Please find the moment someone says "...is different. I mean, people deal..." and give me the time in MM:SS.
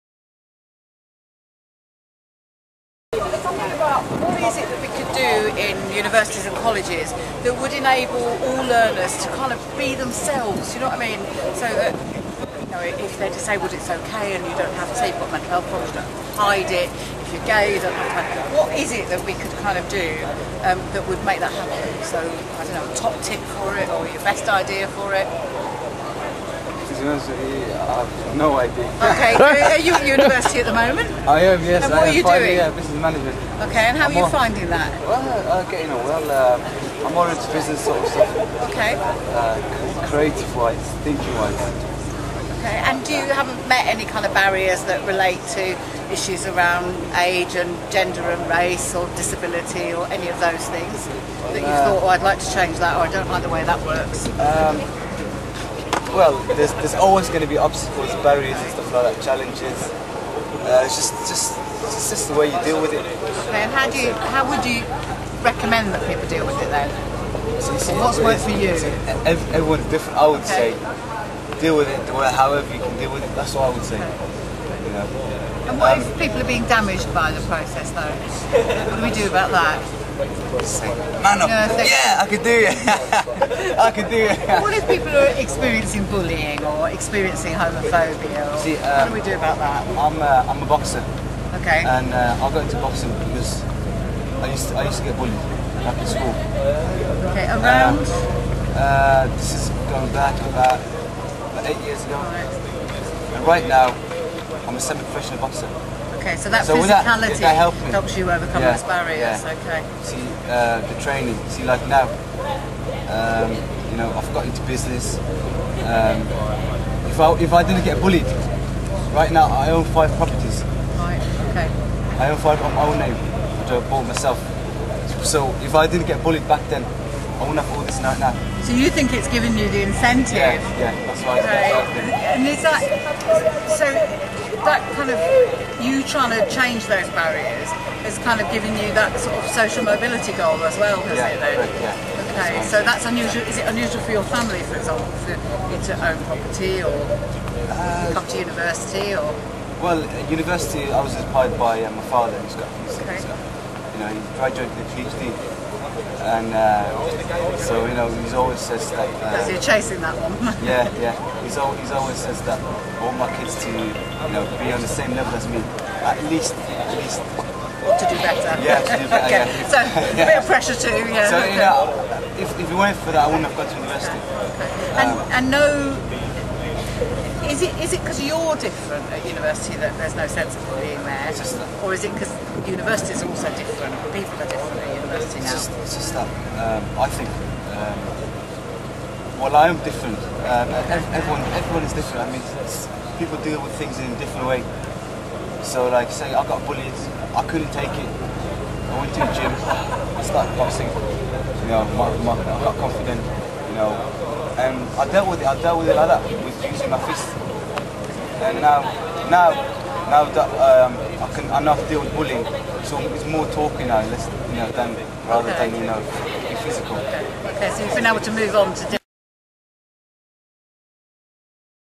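03:11.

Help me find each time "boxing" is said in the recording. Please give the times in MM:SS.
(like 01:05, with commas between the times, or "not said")
01:32, 03:20.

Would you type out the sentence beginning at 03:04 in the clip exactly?
People are different at university it's now.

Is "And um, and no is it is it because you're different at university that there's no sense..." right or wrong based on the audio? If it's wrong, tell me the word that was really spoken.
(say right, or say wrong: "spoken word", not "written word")
right.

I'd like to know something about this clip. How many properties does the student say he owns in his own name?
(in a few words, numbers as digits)
5.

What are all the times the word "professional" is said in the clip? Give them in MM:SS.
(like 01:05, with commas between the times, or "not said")
01:44.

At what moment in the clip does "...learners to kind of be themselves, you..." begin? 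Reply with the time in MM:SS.
00:08.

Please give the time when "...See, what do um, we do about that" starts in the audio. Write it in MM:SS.
01:28.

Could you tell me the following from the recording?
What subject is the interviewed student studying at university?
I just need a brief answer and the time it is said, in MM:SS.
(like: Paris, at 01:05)
Business management, at 00:32.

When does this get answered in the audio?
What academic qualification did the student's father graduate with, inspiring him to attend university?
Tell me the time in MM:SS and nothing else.
02:34.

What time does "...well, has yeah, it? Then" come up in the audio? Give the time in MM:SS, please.
02:20.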